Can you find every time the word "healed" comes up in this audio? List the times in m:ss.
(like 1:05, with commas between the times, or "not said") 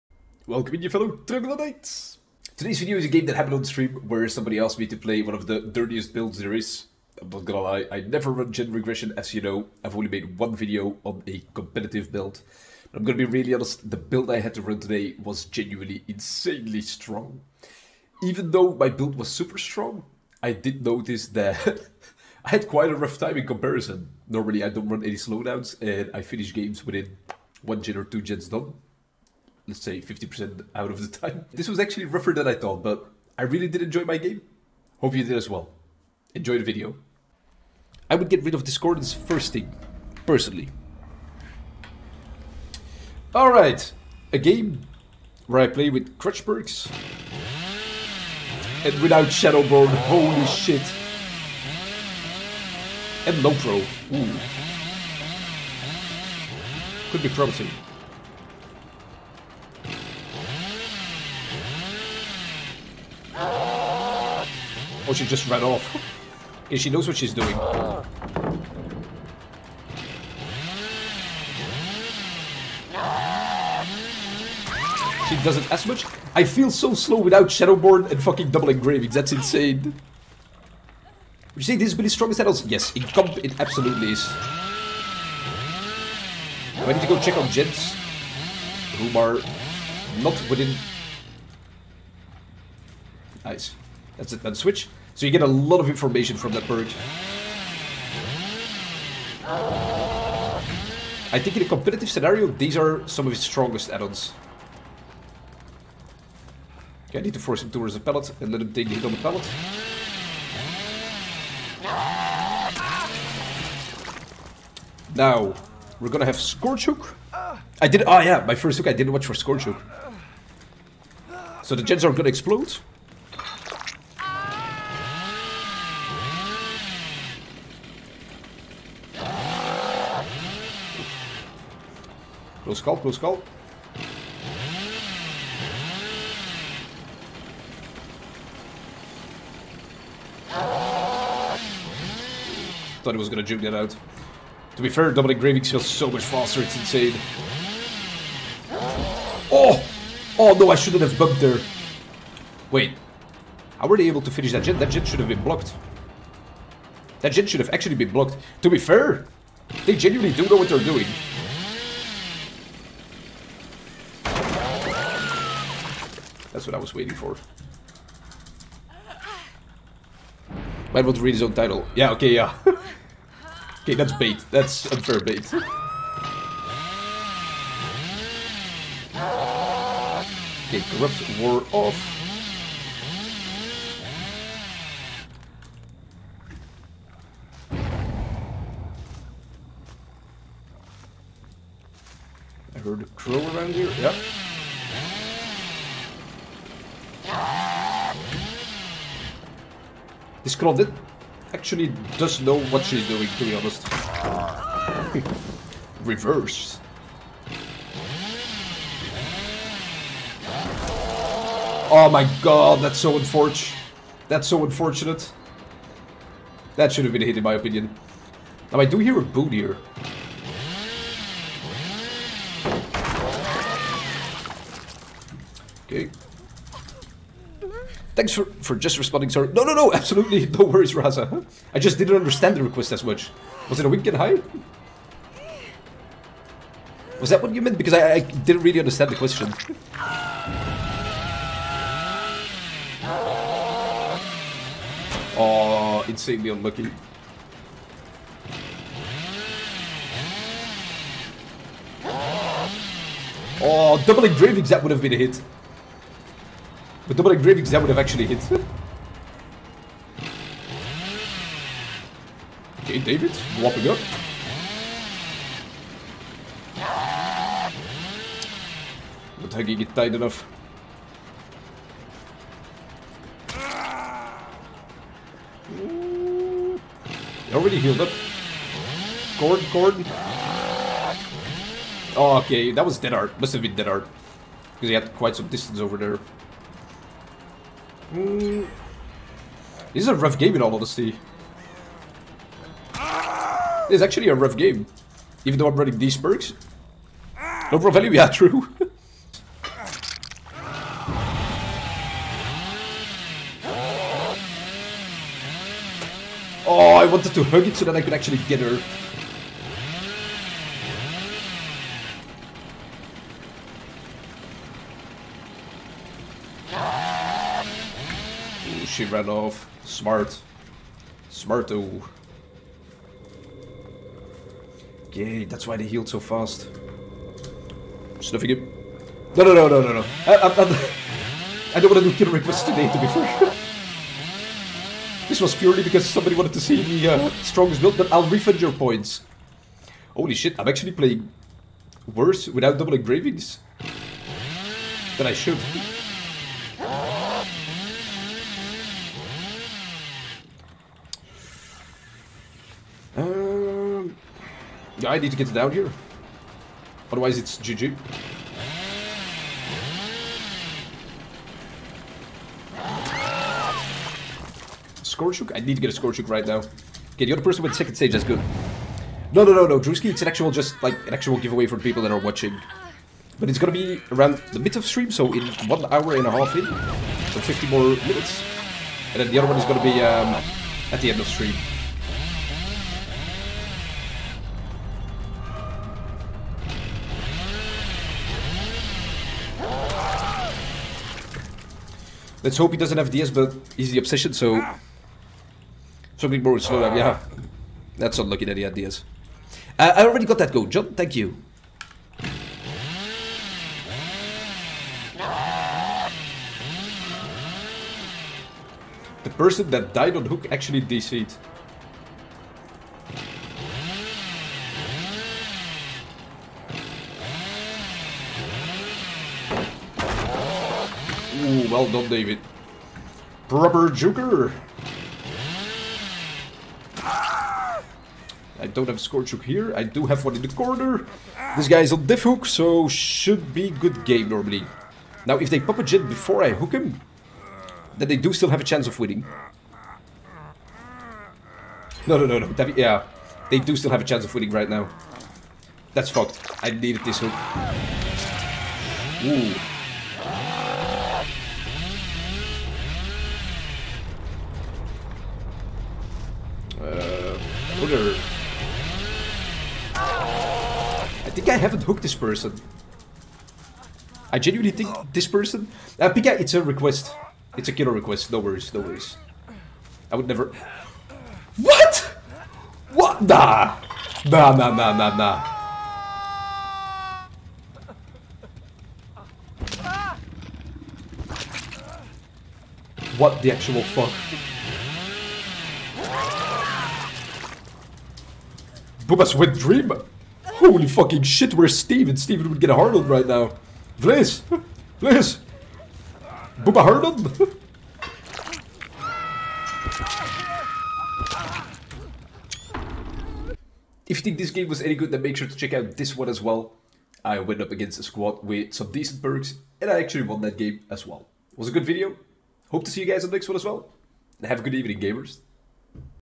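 4:37, 5:25.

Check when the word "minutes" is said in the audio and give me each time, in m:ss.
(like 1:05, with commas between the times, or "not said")
6:18.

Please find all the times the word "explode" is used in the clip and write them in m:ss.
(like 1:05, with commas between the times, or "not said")
2:02.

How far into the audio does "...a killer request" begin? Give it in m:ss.
7:47.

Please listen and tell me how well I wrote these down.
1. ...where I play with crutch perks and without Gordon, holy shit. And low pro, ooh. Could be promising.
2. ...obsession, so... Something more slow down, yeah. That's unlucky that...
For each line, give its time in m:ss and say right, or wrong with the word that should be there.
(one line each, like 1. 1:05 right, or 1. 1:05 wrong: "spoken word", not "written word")
1. 0:45 wrong: "Shadowborn", not "Gordon"
2. 6:33 right.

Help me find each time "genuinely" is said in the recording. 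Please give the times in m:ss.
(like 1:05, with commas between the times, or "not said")
0:15, 2:39, 7:44.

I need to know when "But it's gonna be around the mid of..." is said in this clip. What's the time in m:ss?
6:13.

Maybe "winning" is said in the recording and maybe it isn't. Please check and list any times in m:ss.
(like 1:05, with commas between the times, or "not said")
7:18, 7:24.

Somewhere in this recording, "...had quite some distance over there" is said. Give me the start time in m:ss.
4:44.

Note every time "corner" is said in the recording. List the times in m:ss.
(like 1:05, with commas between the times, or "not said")
7:10.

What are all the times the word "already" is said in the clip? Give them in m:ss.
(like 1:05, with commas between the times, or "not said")
4:37, 6:40.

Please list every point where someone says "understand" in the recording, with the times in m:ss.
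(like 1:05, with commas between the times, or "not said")
3:52, 3:58.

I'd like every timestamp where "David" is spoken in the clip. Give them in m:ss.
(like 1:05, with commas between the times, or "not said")
4:22, 7:02.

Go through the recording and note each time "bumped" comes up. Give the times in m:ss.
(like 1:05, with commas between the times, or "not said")
2:31.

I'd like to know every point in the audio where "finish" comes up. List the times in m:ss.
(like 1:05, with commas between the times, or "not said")
0:26, 2:34.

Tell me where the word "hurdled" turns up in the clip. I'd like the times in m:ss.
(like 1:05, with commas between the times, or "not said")
8:12, 8:16.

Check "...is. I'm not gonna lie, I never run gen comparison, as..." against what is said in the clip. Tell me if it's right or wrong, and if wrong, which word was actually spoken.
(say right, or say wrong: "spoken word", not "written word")
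wrong: "regression", not "comparison".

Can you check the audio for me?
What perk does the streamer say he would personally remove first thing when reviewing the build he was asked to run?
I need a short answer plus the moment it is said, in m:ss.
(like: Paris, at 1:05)
Discordance, at 0:38.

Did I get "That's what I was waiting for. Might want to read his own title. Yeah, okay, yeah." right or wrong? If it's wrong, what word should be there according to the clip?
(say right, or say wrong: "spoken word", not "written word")
right.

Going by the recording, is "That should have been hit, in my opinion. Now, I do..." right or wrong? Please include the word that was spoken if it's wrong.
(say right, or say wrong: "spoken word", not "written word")
right.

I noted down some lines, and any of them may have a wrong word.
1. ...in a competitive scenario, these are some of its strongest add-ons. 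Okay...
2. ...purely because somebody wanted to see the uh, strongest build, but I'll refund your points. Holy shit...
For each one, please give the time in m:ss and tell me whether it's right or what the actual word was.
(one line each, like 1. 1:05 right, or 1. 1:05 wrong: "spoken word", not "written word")
1. 1:41 right
2. 5:35 right.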